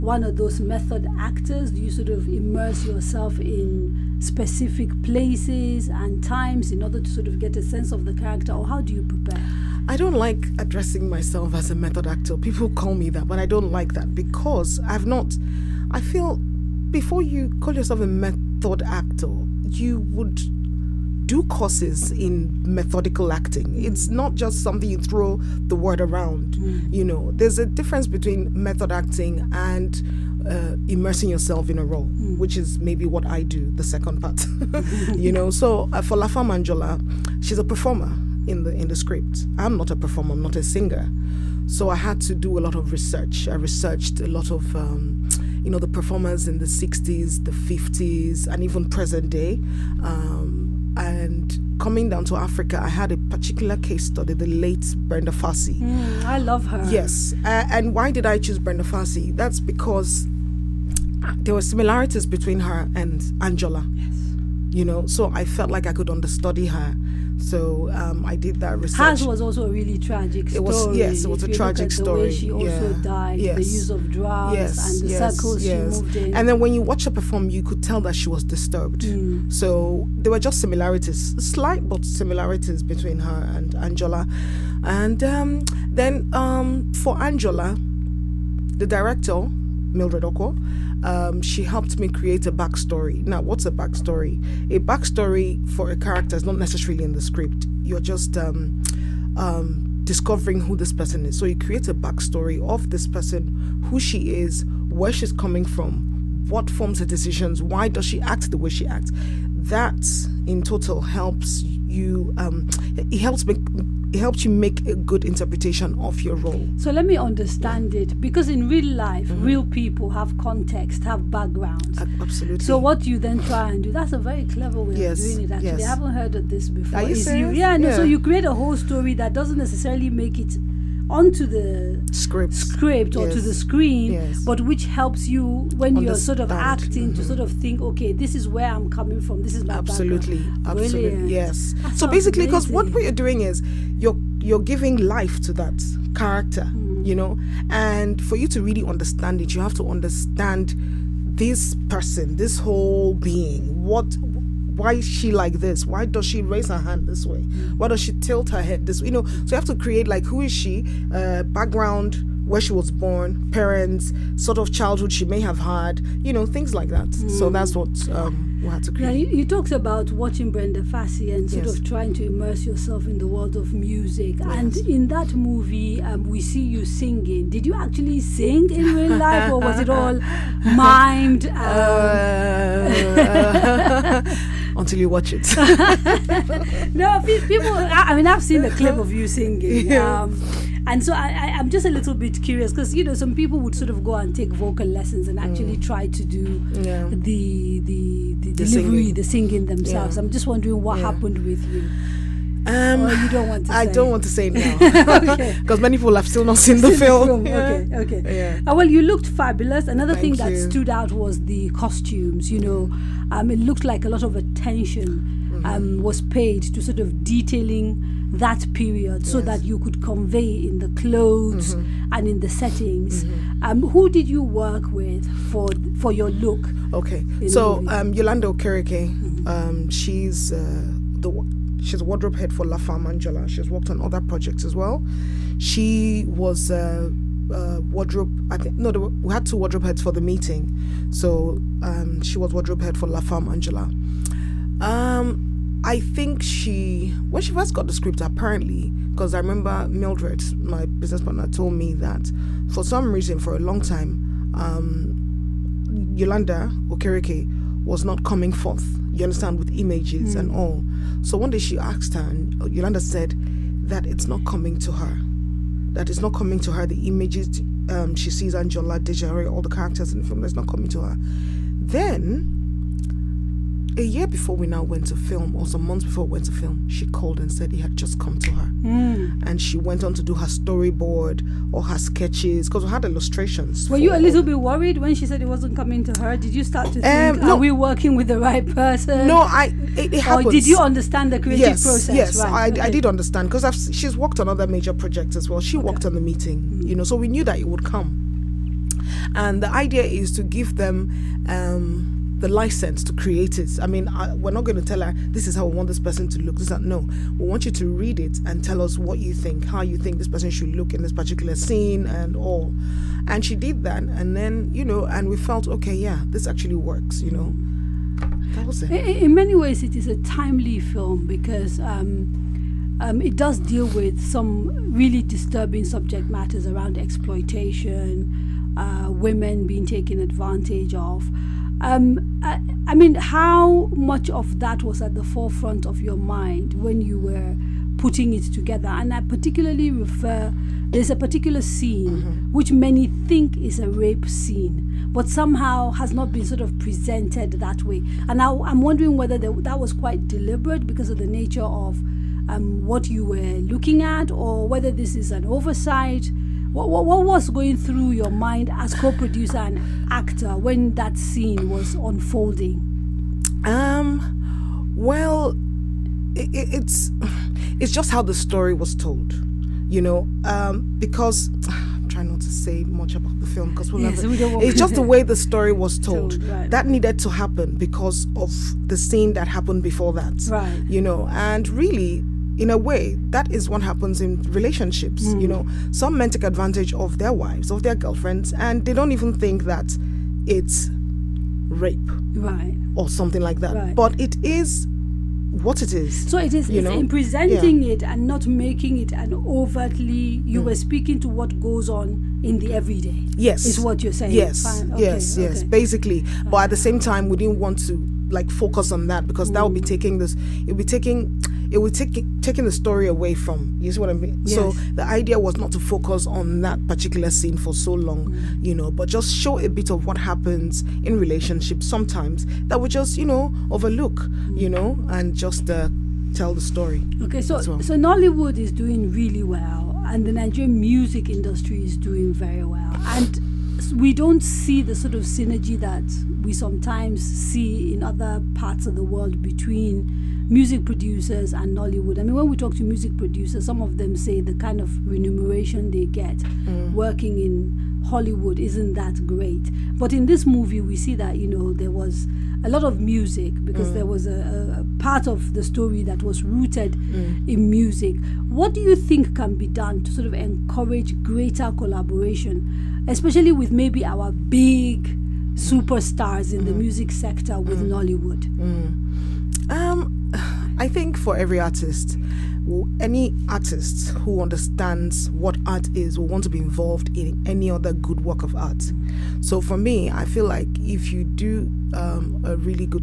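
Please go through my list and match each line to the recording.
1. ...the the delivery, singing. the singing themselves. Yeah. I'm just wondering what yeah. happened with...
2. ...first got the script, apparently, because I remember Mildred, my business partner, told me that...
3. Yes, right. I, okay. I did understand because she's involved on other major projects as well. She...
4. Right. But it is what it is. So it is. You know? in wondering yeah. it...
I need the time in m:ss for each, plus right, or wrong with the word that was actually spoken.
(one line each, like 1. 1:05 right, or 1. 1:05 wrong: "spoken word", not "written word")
1. 3:17 right
2. 4:07 right
3. 4:52 wrong: "worked", not "involved"
4. 6:33 wrong: "presenting", not "wondering".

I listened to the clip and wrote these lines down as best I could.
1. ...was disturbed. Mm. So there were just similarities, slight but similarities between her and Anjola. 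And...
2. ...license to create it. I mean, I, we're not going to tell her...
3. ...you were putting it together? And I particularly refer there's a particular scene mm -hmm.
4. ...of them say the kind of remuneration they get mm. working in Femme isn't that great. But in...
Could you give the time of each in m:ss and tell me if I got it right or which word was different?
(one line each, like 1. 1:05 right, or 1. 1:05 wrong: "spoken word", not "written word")
1. 1:18 right
2. 5:02 right
3. 5:37 right
4. 7:23 wrong: "Nollywood", not "Femme".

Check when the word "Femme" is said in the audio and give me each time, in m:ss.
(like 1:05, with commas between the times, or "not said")
0:36, 3:52, 4:03.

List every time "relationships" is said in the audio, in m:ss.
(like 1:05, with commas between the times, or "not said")
6:24, 7:01.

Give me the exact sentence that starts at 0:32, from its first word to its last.
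which is maybe what I do, the second part.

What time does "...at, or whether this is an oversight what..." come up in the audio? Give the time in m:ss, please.
5:54.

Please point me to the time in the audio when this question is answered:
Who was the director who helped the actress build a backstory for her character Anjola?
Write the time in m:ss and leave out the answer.
1:29.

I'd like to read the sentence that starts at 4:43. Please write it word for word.
Were you a little bit worried when she said it wasn't coming to her?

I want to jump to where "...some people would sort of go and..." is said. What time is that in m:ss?
3:13.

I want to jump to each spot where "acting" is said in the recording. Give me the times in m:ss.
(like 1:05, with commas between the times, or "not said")
0:23, 0:28, 2:16.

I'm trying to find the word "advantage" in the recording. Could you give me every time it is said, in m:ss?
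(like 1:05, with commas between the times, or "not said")
5:30, 6:26.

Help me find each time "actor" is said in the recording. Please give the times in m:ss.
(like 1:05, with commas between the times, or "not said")
0:01, 0:12, 0:18, 6:00.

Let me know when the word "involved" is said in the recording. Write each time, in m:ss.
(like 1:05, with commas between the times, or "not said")
7:56.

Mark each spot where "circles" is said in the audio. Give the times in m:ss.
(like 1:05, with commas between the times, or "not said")
1:15.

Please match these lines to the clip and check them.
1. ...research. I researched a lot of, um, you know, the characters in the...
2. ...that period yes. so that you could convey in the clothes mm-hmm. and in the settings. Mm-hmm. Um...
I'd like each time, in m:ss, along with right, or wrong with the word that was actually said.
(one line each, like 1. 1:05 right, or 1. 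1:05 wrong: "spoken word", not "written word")
1. 0:42 wrong: "performers", not "characters"
2. 3:38 right.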